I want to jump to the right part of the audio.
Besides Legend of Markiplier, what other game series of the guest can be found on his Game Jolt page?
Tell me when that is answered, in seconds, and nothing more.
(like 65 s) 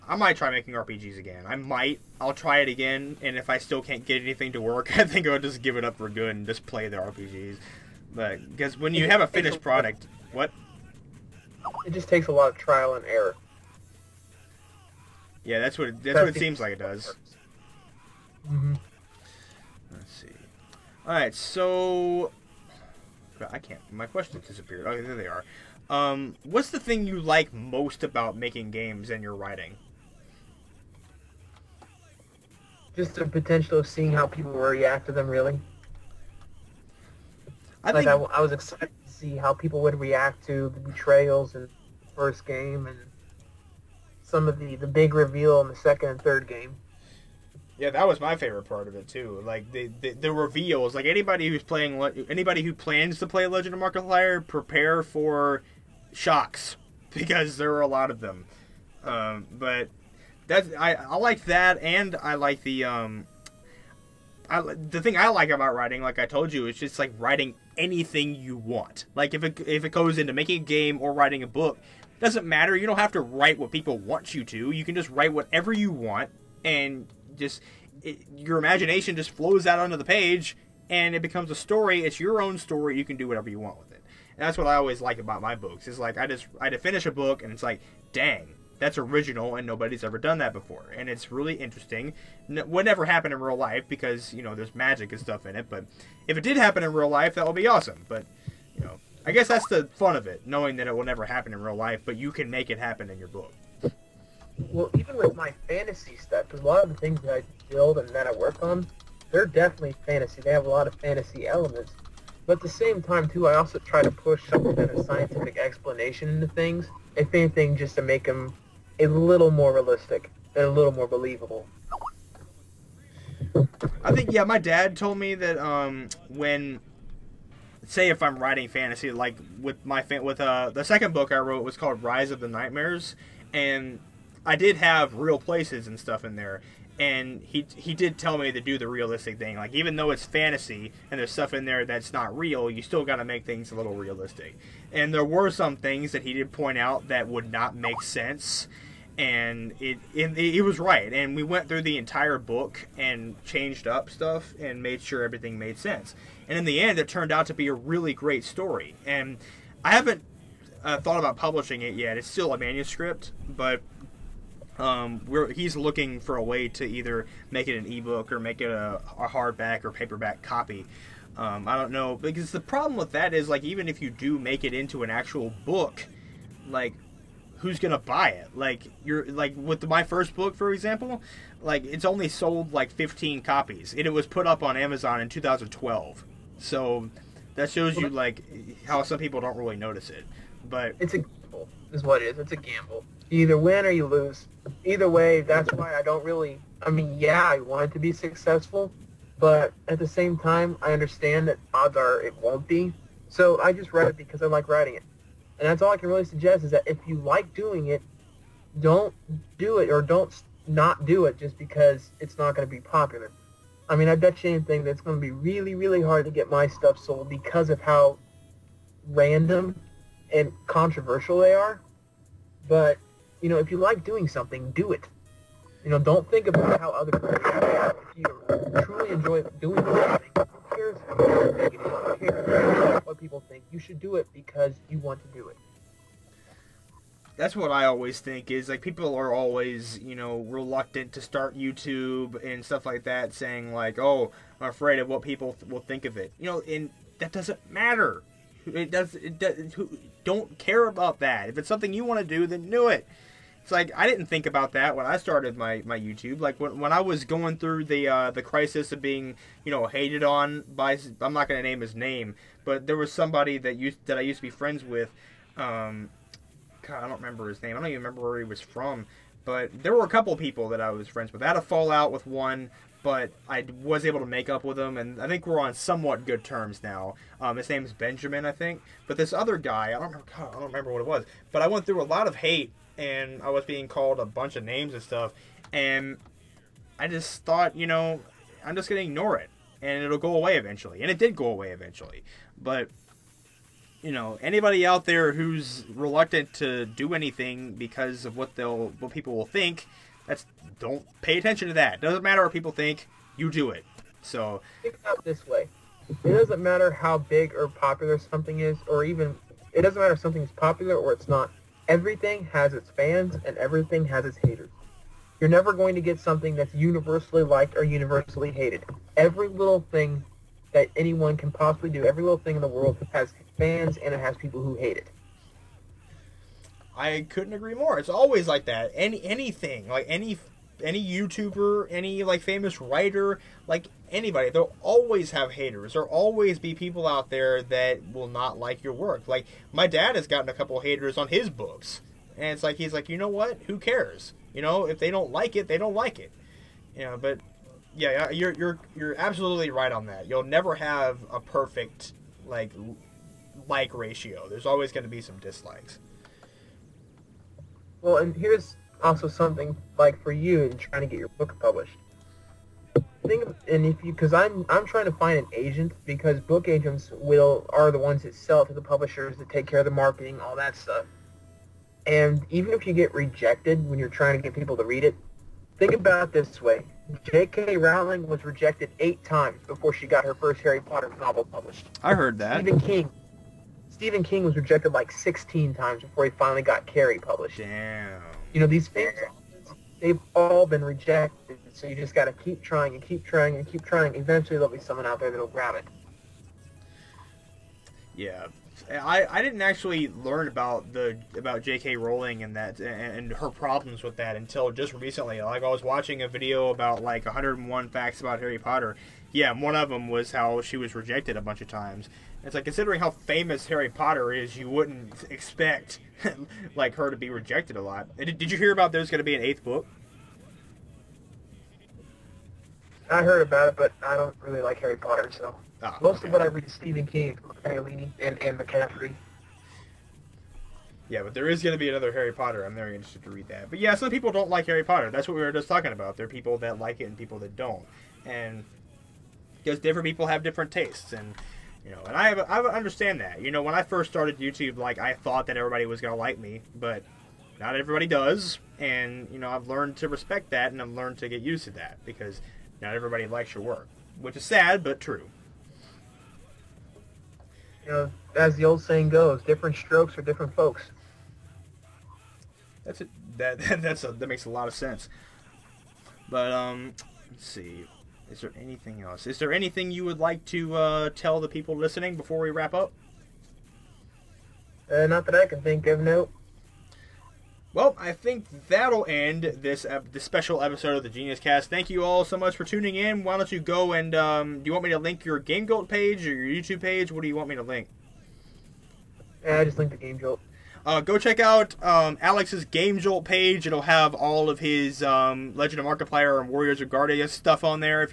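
496 s.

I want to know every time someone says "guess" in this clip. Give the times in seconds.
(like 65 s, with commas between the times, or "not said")
99 s.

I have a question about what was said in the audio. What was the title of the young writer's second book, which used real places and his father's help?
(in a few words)
Rise of the Nightmares.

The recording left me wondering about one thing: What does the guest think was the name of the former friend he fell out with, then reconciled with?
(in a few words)
Benjamin.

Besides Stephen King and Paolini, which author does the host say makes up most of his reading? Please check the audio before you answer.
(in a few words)
McCaffrey.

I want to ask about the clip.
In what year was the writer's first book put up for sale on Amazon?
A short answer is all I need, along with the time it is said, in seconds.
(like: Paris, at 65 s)
2012, at 185 s.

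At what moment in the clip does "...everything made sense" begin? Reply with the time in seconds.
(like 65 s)
155 s.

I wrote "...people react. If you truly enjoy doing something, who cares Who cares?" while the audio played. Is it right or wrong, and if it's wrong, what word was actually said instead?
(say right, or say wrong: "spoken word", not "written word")
right.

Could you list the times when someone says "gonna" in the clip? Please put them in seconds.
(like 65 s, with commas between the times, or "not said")
177 s, 261 s, 446 s.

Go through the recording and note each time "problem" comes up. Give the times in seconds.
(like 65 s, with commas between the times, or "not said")
172 s, 403 s.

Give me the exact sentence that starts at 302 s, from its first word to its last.
Doesn't matter what people think, you do it.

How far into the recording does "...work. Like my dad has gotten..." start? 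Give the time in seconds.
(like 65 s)
338 s.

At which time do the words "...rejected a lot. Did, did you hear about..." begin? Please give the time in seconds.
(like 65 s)
417 s.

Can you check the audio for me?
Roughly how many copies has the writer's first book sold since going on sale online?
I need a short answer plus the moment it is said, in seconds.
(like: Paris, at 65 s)
15, at 182 s.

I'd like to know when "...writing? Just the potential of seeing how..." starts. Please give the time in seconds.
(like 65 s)
29 s.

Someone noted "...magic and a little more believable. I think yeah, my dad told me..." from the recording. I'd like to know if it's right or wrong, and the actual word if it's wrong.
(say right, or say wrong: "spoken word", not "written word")
wrong: "realistic", not "magic".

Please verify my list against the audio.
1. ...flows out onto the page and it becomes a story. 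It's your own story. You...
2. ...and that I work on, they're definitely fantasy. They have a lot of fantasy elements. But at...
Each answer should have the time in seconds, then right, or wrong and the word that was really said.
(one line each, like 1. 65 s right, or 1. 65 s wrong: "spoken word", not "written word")
1. 79 s right
2. 107 s right.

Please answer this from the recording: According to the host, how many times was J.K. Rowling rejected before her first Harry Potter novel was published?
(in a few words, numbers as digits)
8.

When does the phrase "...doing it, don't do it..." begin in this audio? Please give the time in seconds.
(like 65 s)
207 s.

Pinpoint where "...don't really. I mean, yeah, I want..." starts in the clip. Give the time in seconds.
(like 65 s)
196 s.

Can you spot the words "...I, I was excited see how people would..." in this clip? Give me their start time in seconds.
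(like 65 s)
38 s.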